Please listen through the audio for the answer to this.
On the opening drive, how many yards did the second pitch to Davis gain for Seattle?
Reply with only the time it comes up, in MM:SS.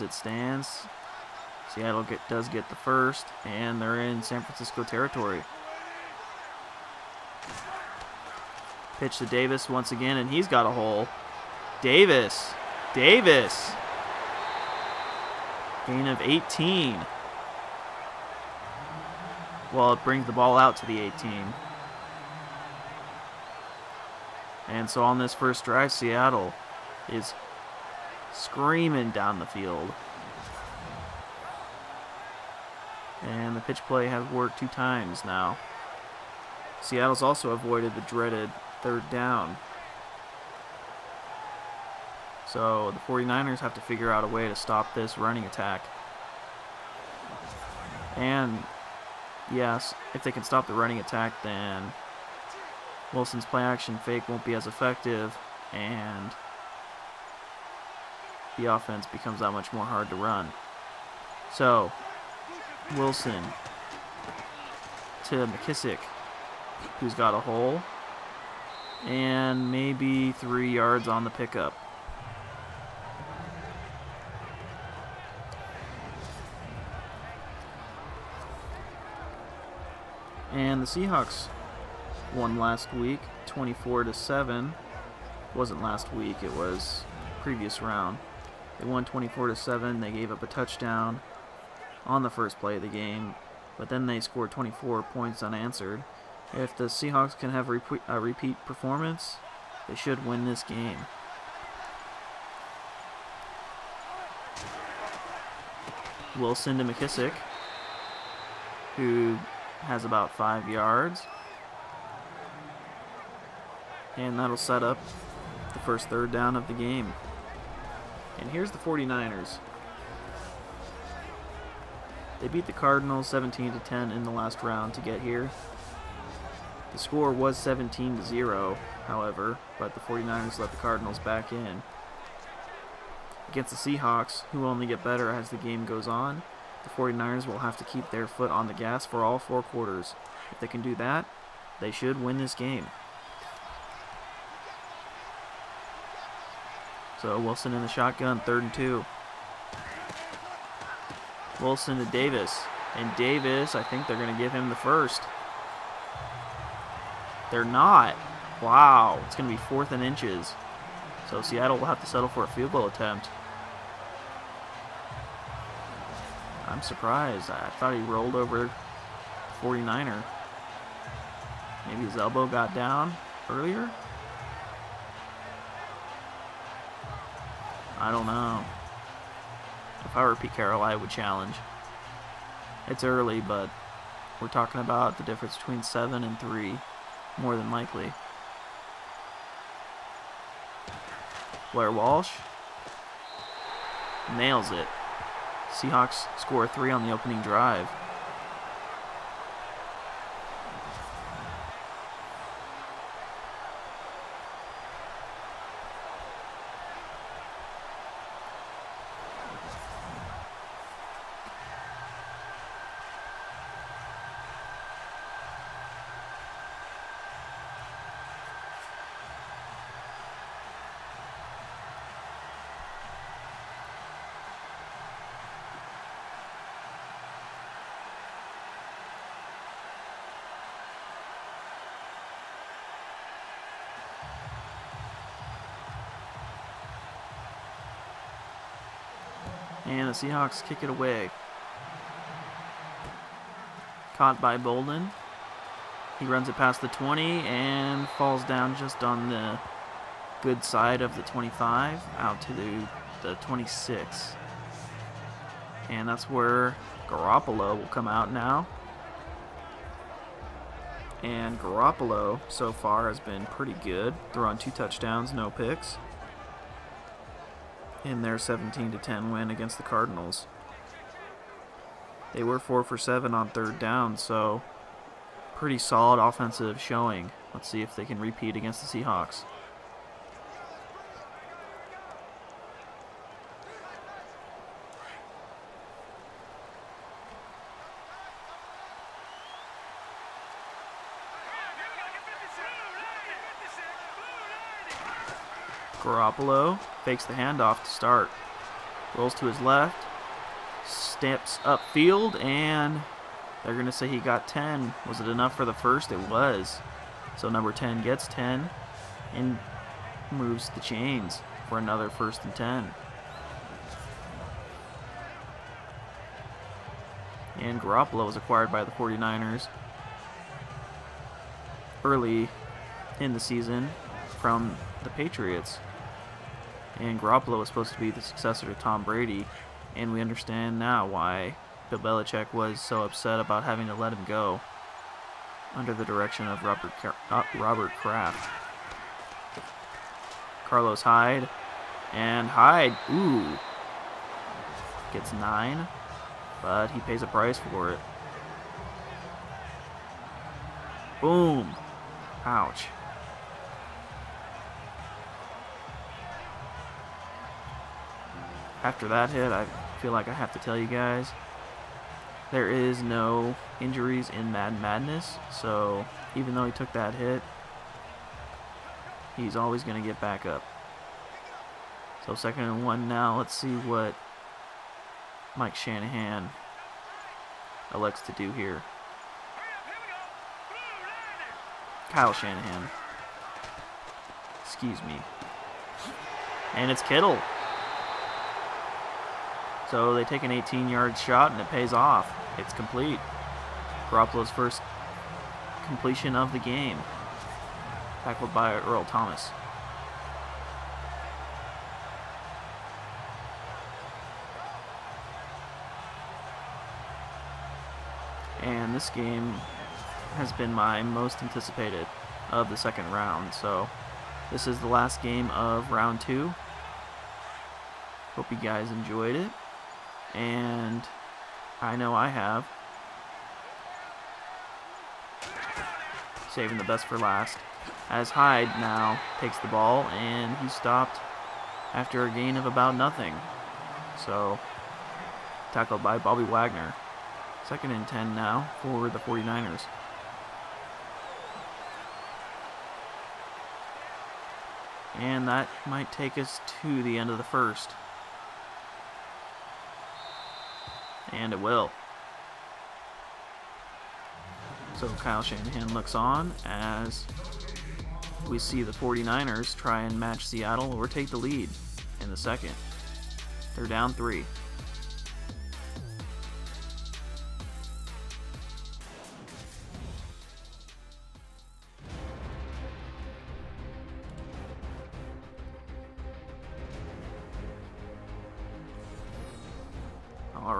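00:15.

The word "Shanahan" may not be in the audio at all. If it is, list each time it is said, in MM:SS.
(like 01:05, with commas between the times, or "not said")
06:15, 06:22, 07:35.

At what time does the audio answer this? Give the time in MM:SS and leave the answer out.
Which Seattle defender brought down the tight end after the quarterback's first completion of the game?
06:38.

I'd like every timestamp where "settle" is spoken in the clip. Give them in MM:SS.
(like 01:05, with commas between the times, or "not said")
02:42.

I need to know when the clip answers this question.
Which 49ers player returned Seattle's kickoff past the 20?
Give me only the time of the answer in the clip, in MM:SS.
04:04.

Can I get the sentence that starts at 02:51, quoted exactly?
Maybe his elbow got down earlier?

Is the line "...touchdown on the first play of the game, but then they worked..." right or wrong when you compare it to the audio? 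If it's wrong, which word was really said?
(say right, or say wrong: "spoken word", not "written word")
wrong: "scored", not "worked".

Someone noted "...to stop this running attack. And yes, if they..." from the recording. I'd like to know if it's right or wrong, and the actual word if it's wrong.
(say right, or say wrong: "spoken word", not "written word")
right.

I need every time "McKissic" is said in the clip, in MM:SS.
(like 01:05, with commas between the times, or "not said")
01:05, 01:46.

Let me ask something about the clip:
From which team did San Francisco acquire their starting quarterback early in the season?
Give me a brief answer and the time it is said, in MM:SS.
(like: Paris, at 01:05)
Patriots, at 05:25.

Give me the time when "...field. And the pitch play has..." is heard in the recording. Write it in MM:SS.
00:29.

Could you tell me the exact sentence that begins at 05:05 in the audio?
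Was it enough for the first?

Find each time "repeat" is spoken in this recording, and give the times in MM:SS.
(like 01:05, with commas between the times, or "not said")
01:38, 04:38.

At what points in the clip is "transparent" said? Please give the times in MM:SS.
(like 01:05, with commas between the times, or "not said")
not said.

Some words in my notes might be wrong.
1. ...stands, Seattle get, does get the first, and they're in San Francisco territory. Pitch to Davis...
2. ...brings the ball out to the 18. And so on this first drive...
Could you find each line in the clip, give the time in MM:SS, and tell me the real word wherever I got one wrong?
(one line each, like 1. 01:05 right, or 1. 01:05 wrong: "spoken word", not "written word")
1. 00:00 right
2. 00:20 right.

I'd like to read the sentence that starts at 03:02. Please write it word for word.
It's early, but we're talking about the difference between 7 and 3, more than likely.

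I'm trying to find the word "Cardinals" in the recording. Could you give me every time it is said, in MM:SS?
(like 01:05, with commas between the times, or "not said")
02:02, 02:10, 04:29.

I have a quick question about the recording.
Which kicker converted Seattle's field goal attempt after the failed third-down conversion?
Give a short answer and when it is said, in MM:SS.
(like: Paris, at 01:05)
Blair Walsh, at 03:11.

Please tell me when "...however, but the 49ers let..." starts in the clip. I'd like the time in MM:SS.
02:09.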